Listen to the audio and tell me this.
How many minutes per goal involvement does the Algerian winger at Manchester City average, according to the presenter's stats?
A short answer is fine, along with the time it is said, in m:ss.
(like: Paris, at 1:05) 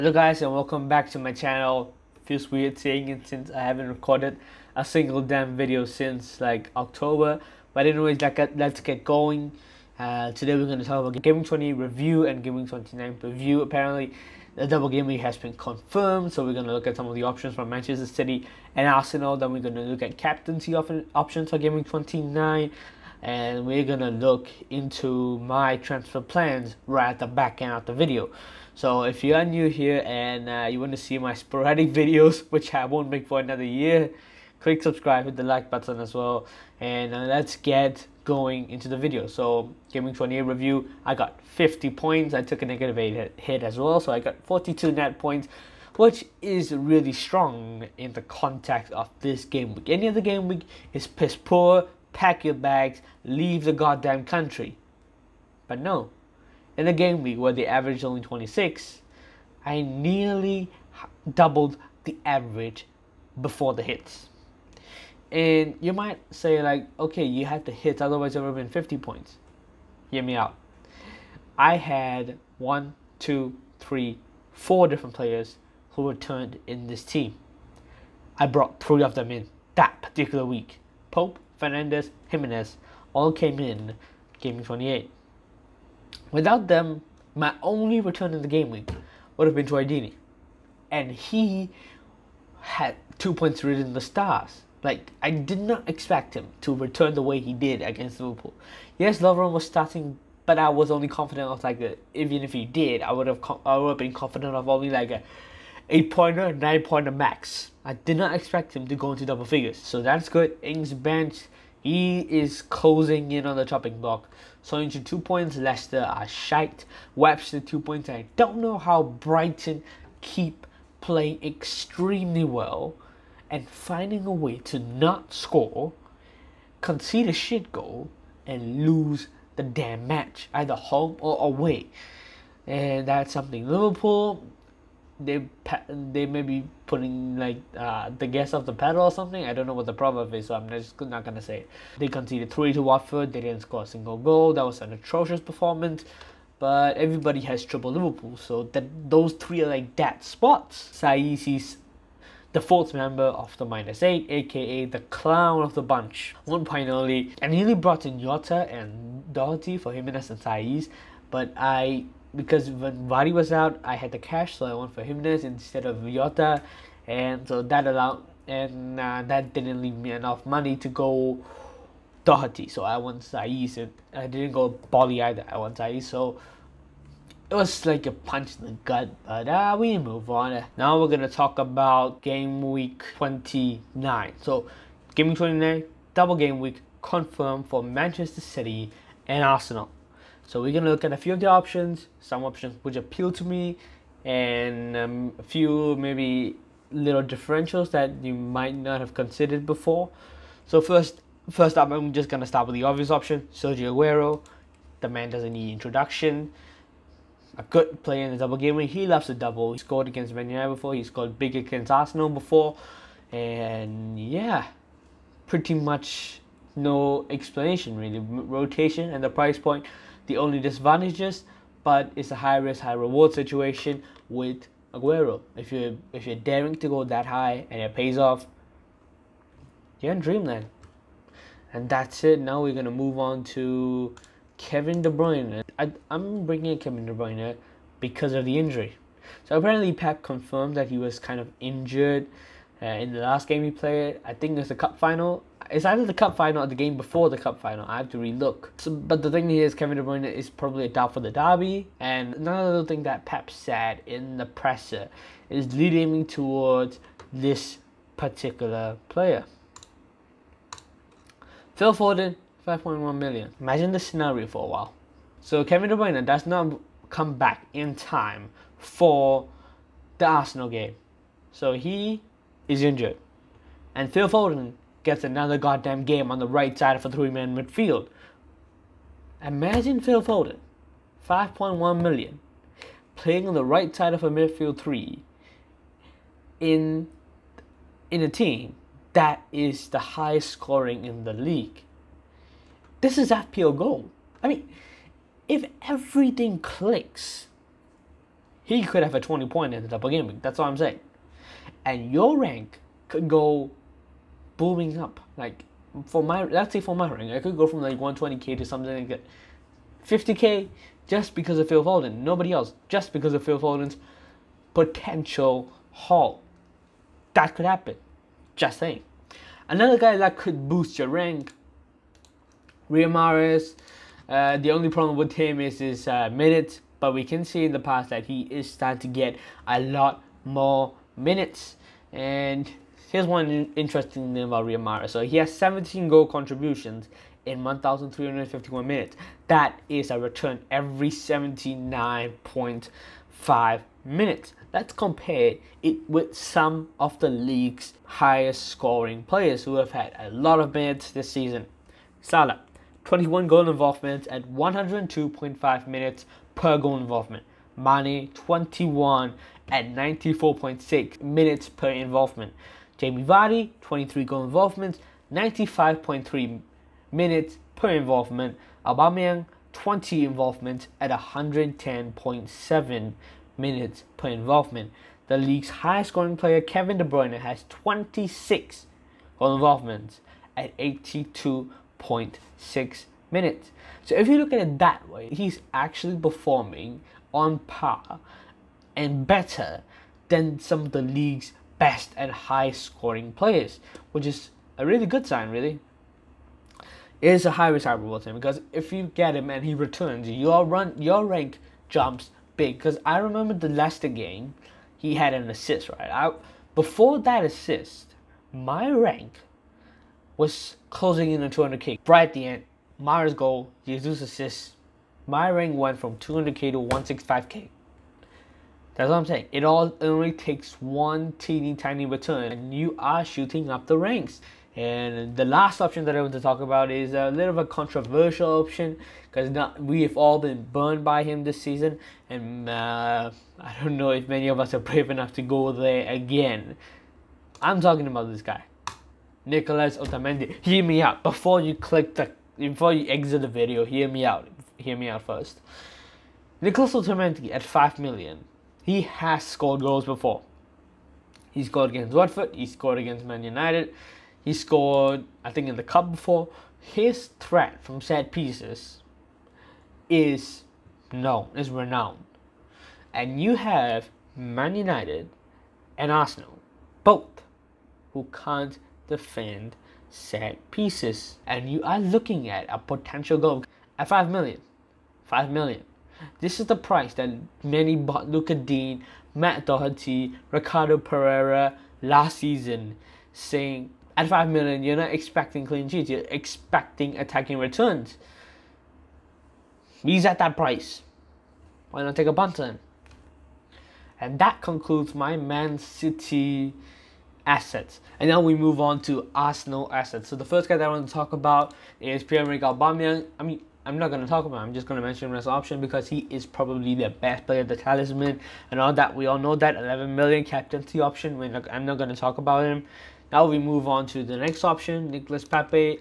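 79.5, at 5:41.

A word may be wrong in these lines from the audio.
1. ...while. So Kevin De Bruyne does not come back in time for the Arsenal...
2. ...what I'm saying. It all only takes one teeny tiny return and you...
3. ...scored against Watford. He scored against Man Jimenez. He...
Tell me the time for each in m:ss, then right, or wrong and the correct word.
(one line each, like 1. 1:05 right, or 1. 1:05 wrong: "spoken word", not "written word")
1. 4:24 right
2. 6:59 right
3. 7:31 wrong: "United", not "Jimenez".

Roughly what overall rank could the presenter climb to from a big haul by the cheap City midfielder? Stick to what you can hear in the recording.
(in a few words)
50k.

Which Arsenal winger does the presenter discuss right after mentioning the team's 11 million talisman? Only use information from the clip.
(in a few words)
Nicolas Pepe.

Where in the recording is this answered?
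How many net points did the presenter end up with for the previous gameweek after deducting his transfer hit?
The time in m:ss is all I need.
0:44.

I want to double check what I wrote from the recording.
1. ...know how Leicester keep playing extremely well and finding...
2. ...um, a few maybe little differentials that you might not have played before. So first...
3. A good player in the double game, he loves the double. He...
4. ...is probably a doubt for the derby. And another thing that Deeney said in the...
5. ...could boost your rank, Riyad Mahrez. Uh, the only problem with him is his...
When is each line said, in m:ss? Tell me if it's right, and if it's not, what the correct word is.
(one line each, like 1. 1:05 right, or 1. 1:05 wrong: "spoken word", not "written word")
1. 1:58 wrong: "Brighton", not "Leicester"
2. 3:14 wrong: "considered", not "played"
3. 3:27 right
4. 4:10 wrong: "Pep", not "Deeney"
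5. 5:20 right.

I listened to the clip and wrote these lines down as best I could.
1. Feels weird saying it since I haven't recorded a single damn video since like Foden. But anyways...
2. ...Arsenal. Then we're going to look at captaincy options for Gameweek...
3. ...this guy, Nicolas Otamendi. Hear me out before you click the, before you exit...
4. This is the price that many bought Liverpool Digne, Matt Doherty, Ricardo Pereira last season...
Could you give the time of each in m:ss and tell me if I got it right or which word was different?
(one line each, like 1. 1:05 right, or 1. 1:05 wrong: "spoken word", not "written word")
1. 0:02 wrong: "October", not "Foden"
2. 0:18 right
3. 7:18 right
4. 7:56 wrong: "Lucas", not "Liverpool".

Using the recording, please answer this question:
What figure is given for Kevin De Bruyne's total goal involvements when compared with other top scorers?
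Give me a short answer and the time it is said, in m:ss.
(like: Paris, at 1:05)
26, at 6:17.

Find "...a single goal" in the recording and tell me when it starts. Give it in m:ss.
2:23.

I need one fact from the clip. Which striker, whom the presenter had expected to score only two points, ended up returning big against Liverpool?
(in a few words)
Troy Deeney.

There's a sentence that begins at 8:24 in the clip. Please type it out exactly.
I'm just going to mention him as an option because he is probably the best player, the talisman, and all that.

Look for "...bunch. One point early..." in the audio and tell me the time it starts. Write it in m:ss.
2:35.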